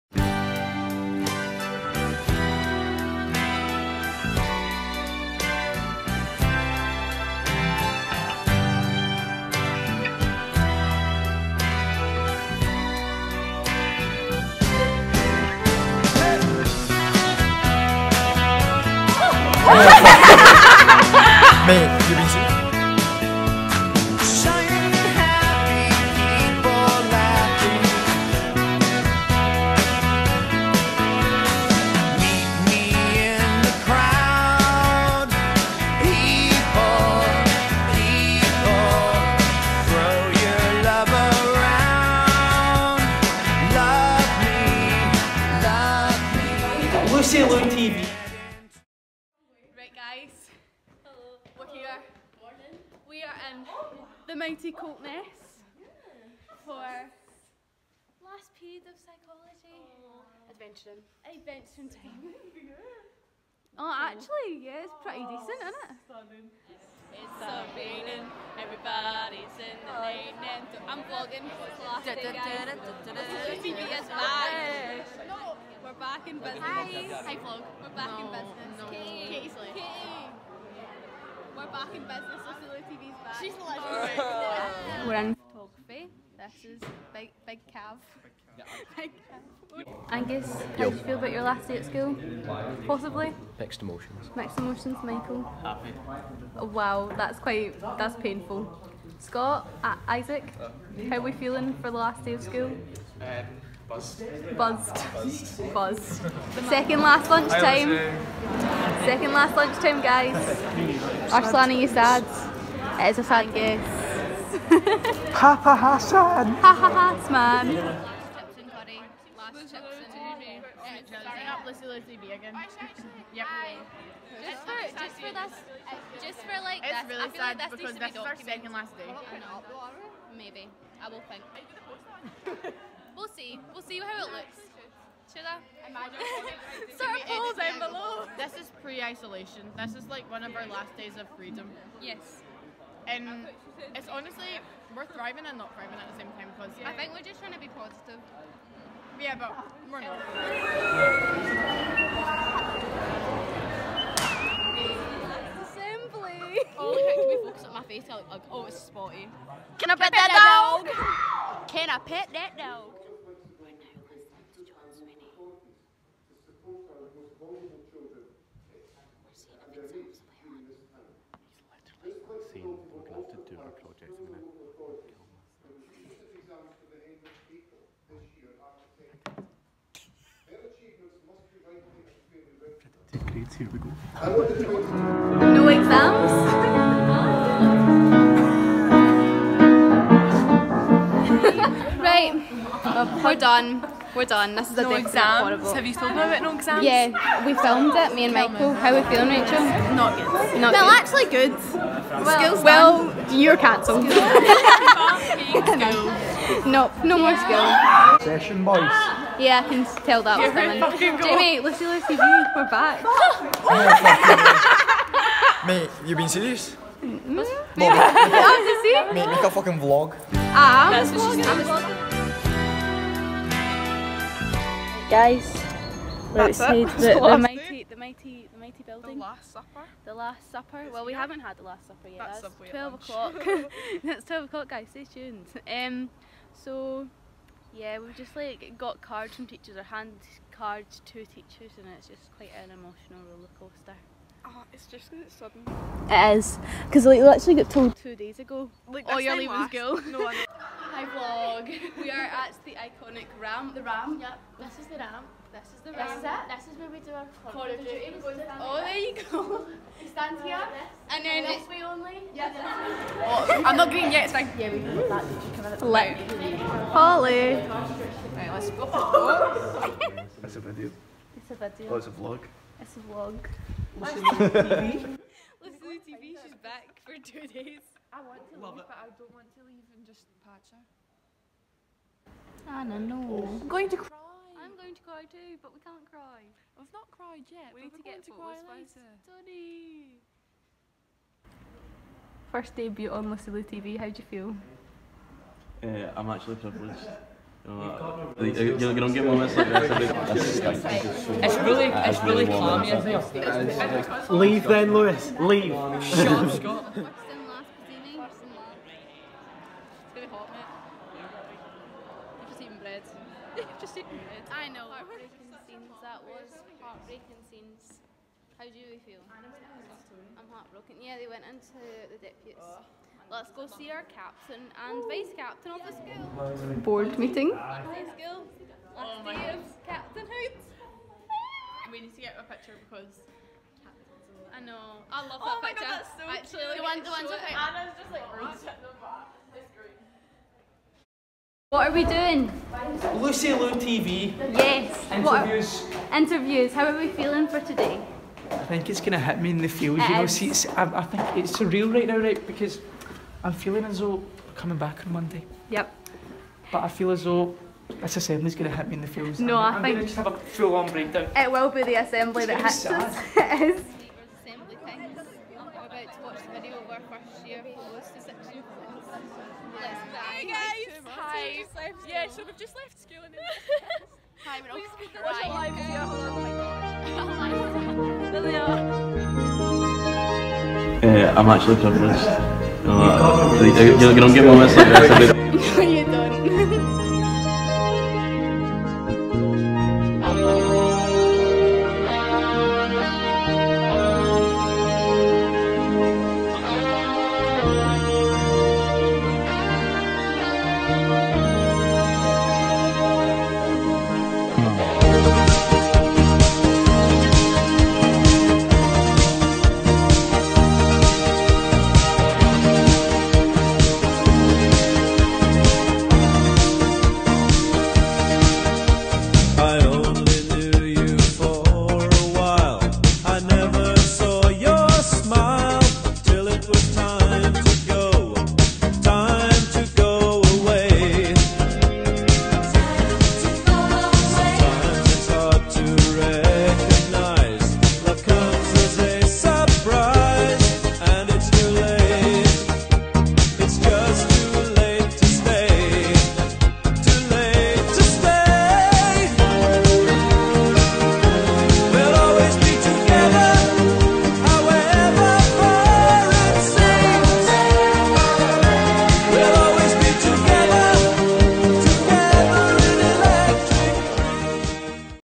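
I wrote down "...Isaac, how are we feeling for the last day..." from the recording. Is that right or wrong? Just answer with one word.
right.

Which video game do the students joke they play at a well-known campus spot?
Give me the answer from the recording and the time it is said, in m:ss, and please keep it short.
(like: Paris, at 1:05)
Call of Duty, at 4:17.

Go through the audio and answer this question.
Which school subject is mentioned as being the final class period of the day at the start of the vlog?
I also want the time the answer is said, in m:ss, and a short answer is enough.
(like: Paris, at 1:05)
psychology, at 0:58.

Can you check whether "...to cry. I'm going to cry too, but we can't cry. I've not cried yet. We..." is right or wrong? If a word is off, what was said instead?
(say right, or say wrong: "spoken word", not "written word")
right.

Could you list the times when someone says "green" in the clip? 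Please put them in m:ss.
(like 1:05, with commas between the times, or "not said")
4:23.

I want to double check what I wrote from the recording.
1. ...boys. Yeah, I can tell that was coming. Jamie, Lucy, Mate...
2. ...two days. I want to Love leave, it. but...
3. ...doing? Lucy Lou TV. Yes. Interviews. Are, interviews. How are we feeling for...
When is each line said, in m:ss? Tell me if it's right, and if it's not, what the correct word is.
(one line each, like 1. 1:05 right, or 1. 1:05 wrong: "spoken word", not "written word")
1. 3:28 wrong: "Lucy", not "Mate"
2. 4:37 right
3. 5:42 right.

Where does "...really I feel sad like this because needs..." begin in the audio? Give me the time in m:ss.
2:07.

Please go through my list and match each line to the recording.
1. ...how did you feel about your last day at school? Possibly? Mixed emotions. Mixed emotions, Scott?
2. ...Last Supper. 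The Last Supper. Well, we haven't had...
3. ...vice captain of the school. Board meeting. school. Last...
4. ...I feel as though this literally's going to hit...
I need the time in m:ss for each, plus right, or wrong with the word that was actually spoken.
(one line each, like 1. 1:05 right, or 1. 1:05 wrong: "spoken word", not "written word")
1. 1:30 wrong: "Michael", not "Scott"
2. 3:49 right
3. 5:25 right
4. 5:56 wrong: "assembly", not "literally".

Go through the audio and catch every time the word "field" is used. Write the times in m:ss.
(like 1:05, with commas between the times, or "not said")
5:49, 5:59.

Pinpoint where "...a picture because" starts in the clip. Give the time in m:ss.
5:32.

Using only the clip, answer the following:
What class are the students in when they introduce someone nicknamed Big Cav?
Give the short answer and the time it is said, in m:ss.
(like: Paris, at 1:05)
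photography, at 1:25.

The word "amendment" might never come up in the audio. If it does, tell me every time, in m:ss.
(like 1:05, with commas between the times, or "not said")
not said.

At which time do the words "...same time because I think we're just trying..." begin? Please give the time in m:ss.
2:26.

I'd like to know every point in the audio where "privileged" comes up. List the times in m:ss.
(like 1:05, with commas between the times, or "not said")
4:56.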